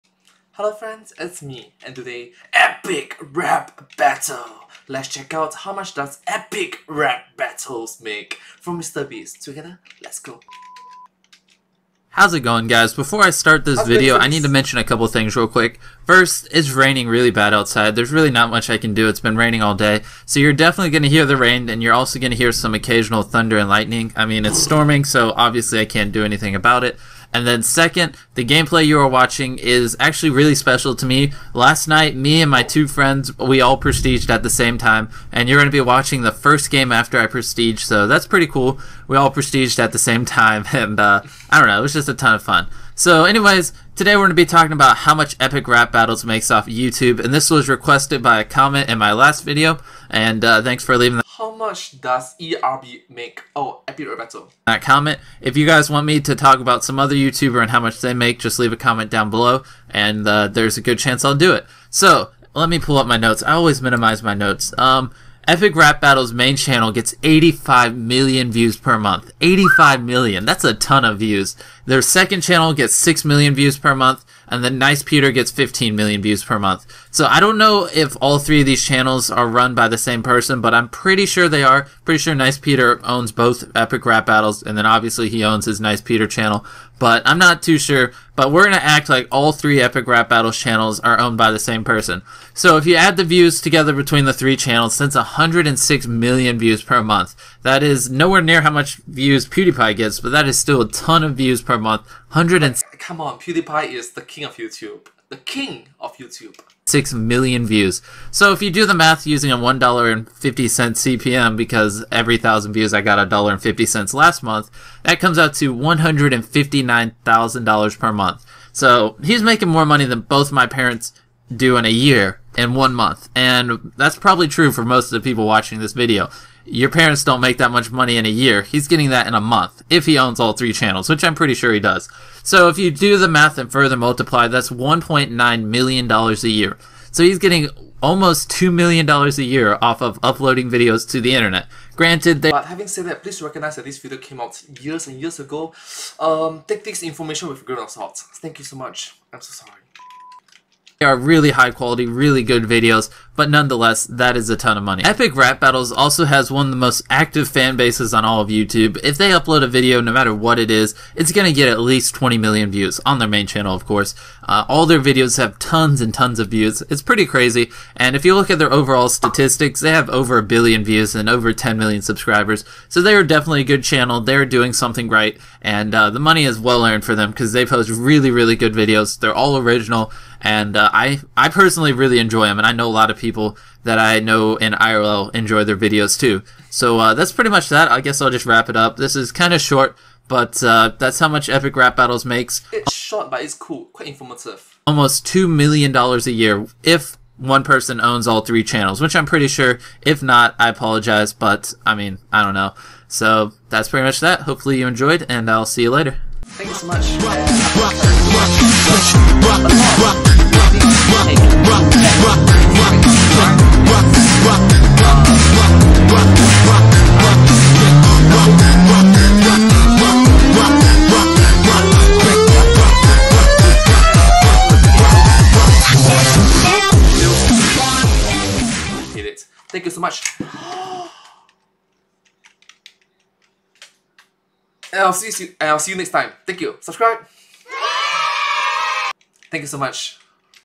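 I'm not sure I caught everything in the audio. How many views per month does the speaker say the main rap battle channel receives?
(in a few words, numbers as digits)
85 million.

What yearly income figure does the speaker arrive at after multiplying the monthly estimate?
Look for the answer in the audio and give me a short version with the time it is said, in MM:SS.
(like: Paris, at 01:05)
$1.9 million, at 02:14.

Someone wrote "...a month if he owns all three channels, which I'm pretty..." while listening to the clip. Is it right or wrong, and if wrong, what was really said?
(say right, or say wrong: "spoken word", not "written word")
right.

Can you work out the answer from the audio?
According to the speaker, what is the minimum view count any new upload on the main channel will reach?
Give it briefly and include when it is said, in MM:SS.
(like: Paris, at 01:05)
20 million, at 02:42.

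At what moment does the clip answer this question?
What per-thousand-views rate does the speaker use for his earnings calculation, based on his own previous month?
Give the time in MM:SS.
01:49.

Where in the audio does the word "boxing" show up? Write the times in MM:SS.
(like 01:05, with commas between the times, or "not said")
not said.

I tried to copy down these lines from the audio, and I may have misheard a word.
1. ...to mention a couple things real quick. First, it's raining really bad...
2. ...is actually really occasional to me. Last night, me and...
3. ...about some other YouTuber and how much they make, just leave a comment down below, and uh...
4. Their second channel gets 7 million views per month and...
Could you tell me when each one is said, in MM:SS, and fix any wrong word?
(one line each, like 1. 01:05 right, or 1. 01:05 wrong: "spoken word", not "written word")
1. 00:14 right
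2. 00:29 wrong: "special", not "occasional"
3. 00:56 right
4. 01:11 wrong: "6", not "7".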